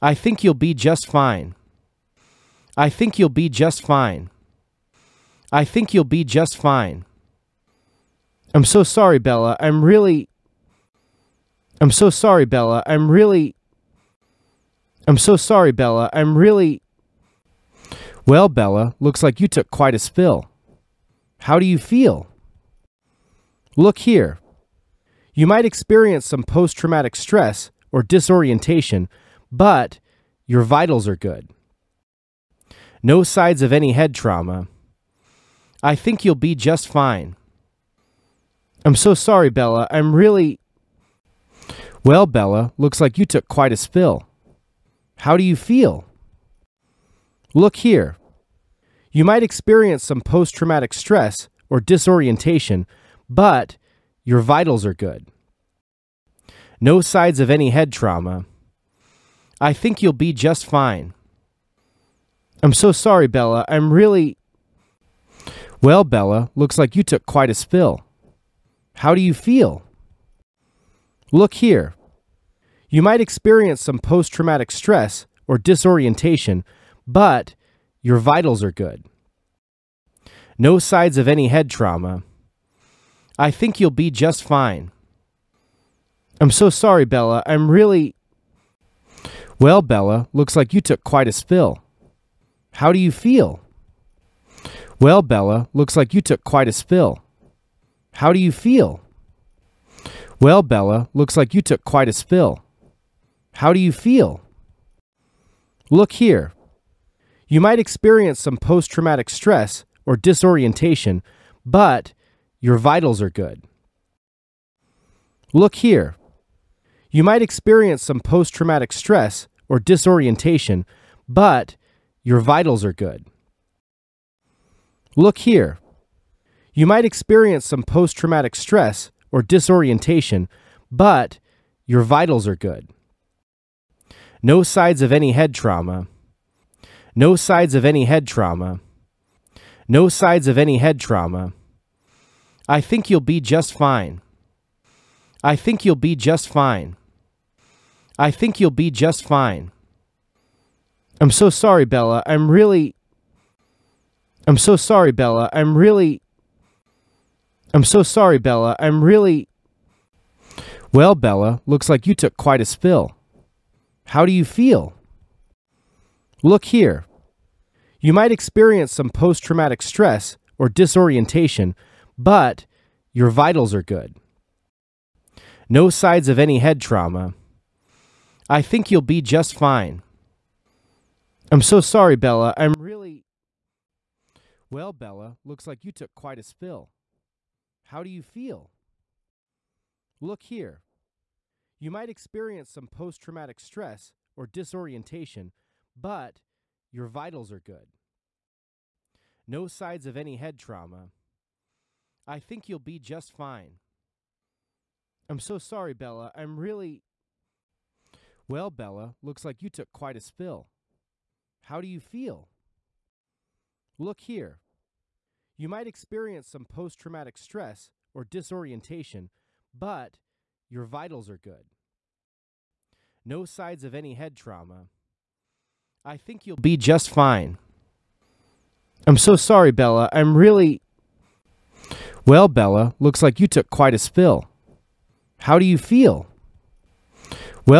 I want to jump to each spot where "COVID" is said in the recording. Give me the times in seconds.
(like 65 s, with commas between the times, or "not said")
not said.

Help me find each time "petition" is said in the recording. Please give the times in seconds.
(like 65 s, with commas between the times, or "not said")
not said.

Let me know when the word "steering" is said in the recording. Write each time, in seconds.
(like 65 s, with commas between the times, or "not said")
not said.